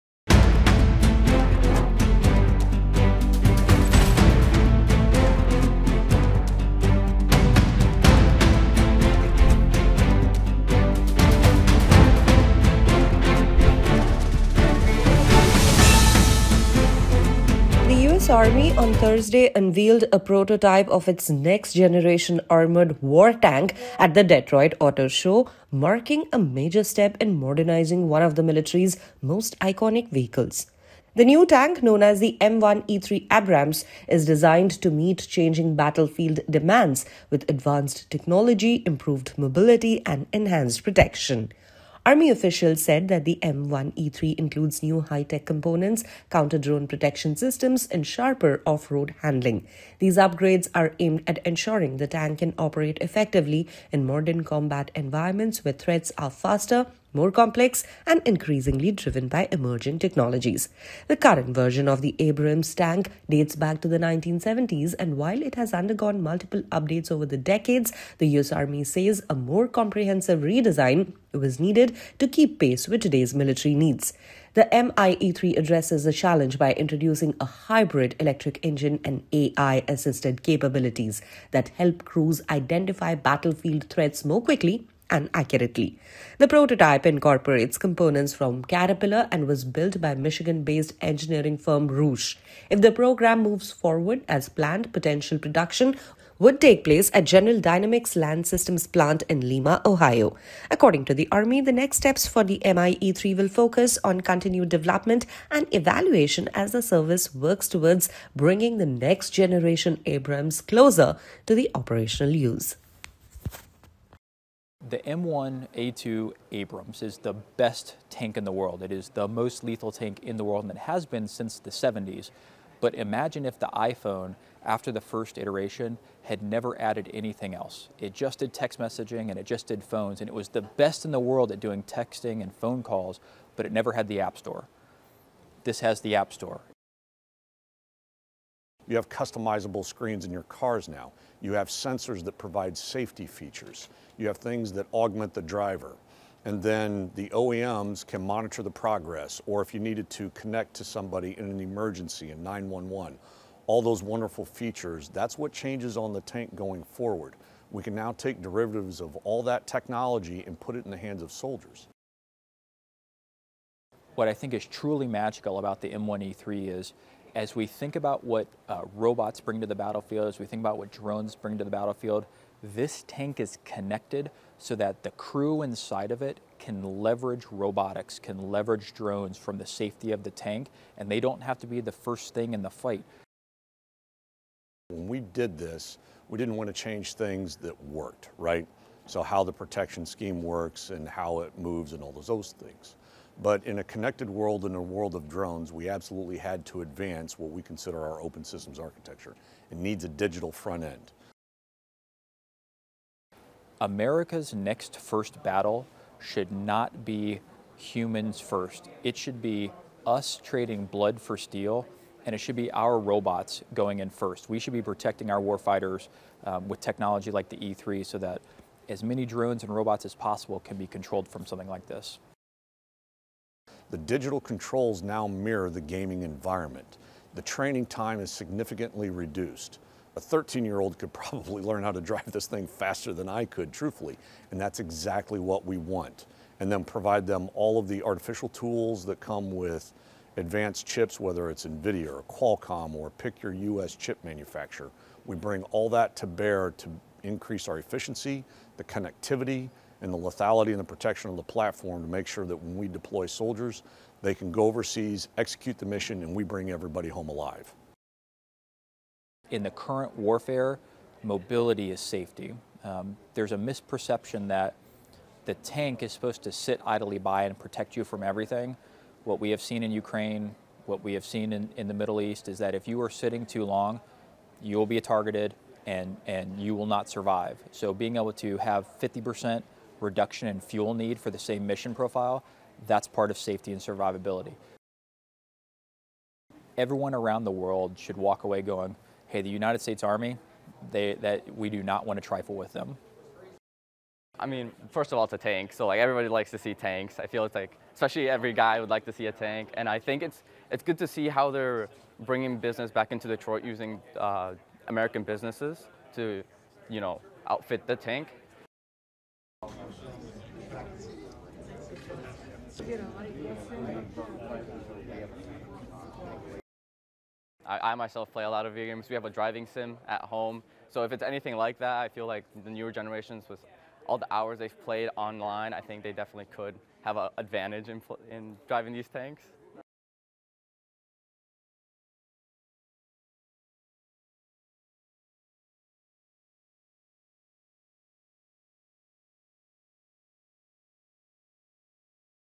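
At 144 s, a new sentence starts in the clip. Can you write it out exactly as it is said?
You have things that augment the driver.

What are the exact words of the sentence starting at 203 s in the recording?
America's next first battle should not be humans first.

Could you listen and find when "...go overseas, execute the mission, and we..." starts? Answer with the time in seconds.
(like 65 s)
254 s.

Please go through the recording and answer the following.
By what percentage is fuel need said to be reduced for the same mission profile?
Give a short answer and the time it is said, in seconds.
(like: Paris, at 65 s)
50%, at 278 s.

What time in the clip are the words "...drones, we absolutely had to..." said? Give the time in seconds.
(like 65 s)
195 s.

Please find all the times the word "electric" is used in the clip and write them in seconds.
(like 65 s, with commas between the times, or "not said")
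78 s.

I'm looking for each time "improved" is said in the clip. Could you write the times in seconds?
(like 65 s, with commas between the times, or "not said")
38 s.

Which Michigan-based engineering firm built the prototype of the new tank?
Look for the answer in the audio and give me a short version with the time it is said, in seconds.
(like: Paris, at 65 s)
Roush, at 91 s.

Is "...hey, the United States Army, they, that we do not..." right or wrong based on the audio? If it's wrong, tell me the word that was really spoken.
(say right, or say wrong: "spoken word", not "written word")
right.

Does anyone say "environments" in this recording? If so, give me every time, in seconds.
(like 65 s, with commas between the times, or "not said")
54 s, 226 s.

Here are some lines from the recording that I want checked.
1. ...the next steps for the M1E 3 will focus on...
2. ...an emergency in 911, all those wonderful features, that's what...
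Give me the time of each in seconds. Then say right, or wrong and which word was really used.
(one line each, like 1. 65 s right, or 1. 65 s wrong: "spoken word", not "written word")
1. 101 s right
2. 151 s right.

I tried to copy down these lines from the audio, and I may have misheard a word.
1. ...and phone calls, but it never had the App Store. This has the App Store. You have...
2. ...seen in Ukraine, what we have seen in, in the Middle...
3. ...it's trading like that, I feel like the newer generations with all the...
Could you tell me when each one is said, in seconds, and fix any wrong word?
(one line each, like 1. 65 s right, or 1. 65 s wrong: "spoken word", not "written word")
1. 132 s right
2. 269 s right
3. 321 s wrong: "anything", not "trading".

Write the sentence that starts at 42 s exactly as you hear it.
Army officials said that the M1E3 includes new high tech components, counter drone protection systems, and sharper off road handling.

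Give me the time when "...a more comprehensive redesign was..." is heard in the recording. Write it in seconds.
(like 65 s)
69 s.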